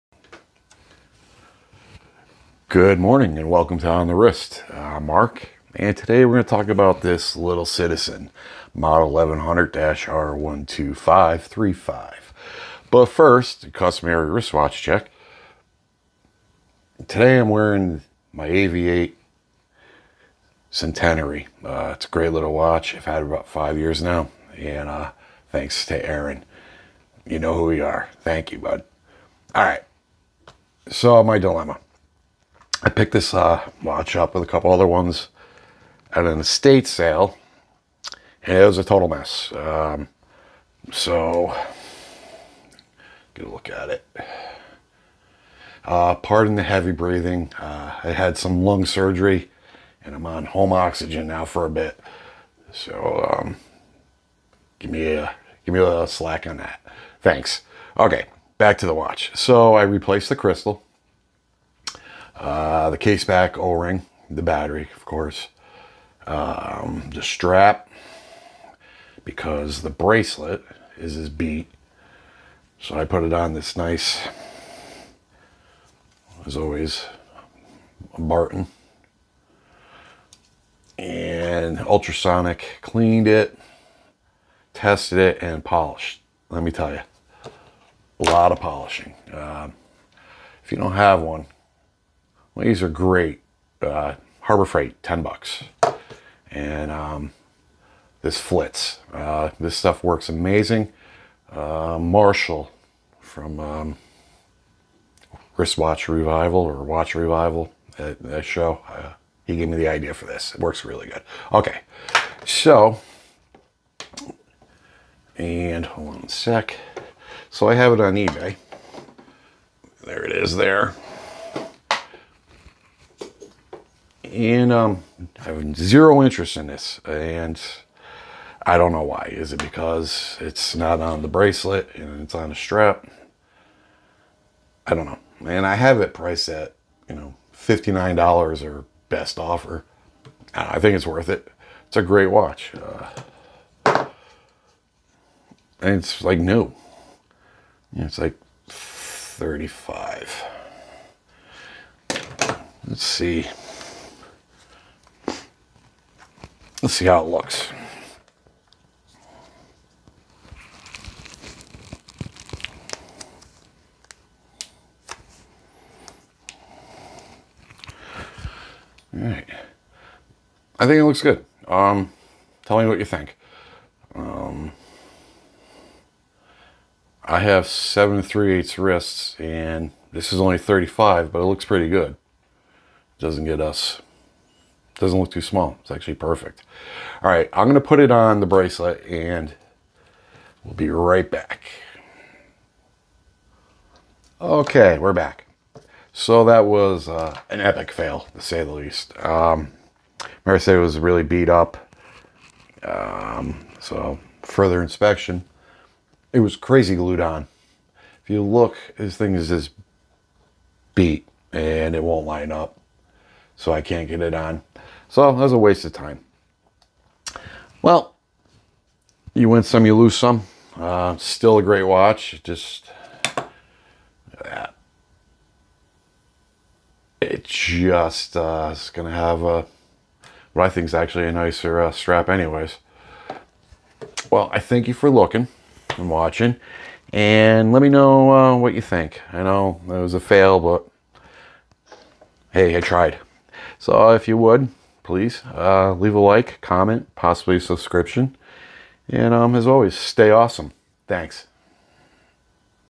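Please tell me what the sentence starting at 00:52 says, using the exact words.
So, um, give me a give me a little slack on that.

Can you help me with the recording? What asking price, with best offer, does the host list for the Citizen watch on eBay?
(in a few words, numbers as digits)
$59.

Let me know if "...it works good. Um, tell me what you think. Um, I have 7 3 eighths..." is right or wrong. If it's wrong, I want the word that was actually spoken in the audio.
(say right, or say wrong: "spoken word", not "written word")
wrong: "looks", not "works".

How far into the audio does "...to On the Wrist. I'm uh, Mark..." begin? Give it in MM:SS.
00:03.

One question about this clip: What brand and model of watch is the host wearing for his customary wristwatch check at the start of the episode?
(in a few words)
AVI-8 Centenary.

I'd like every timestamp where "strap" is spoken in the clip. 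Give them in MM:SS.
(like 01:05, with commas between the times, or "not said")
01:07, 02:12, 03:51.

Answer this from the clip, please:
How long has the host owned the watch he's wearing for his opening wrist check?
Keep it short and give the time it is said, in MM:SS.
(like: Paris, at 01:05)
about 5 years, at 00:23.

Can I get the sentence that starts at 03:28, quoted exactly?
If you look, this thing is just beat and it won't line up so I can't get it on.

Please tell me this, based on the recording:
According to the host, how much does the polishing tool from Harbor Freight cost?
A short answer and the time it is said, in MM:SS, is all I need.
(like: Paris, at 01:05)
$10, at 01:35.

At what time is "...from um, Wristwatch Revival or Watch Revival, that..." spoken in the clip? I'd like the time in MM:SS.
01:43.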